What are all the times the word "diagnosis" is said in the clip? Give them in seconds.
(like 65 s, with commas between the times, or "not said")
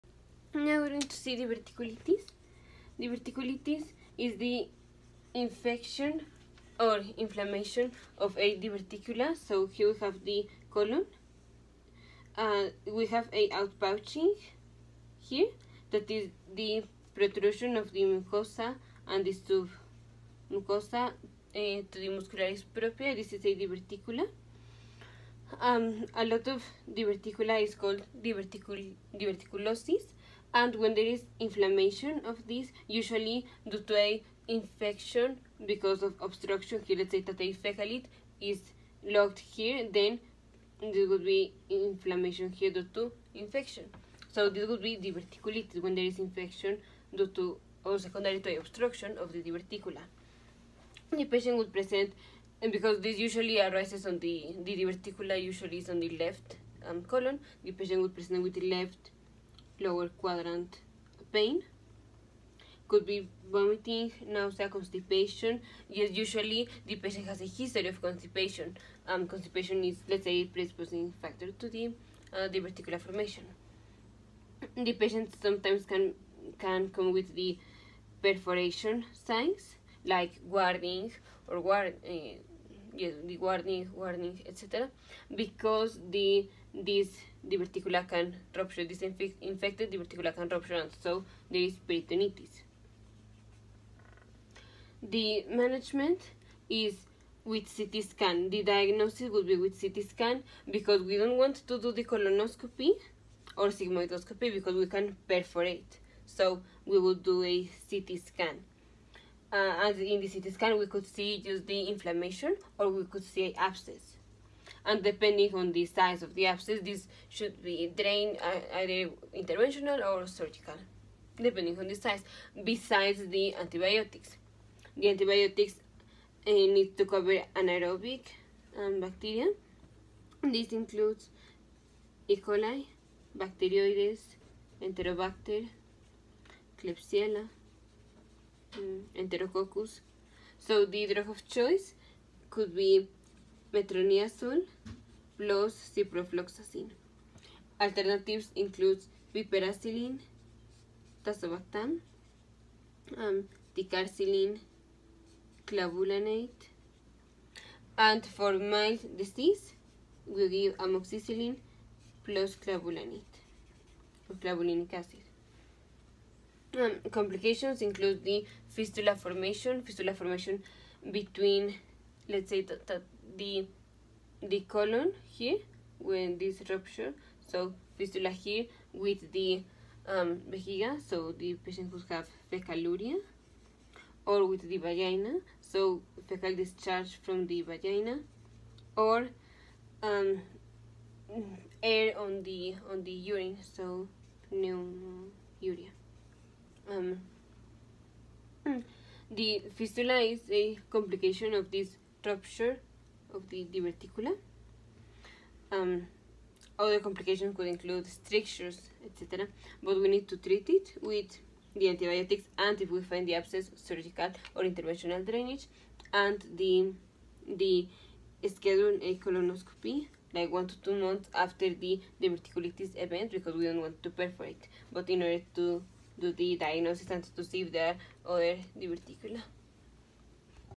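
98 s, 226 s.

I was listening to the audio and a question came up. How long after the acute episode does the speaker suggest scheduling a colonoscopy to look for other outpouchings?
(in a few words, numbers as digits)
1 to 2 months.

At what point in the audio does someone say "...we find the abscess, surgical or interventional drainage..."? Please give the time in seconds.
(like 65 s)
212 s.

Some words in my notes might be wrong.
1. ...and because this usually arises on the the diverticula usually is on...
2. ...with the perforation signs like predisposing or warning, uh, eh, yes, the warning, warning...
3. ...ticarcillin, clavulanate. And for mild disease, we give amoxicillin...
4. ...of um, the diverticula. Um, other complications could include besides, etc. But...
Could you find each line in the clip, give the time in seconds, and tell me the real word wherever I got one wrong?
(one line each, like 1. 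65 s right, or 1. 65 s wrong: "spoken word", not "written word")
1. 52 s right
2. 77 s wrong: "warning", not "predisposing"
3. 153 s right
4. 203 s wrong: "strictures", not "besides".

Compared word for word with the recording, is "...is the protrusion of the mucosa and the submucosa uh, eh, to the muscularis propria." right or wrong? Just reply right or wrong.
right.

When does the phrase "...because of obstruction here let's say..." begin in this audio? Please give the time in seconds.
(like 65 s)
35 s.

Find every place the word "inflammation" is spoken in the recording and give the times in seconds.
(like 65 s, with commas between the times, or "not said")
7 s, 31 s, 41 s, 111 s.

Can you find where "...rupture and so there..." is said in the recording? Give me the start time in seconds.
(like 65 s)
90 s.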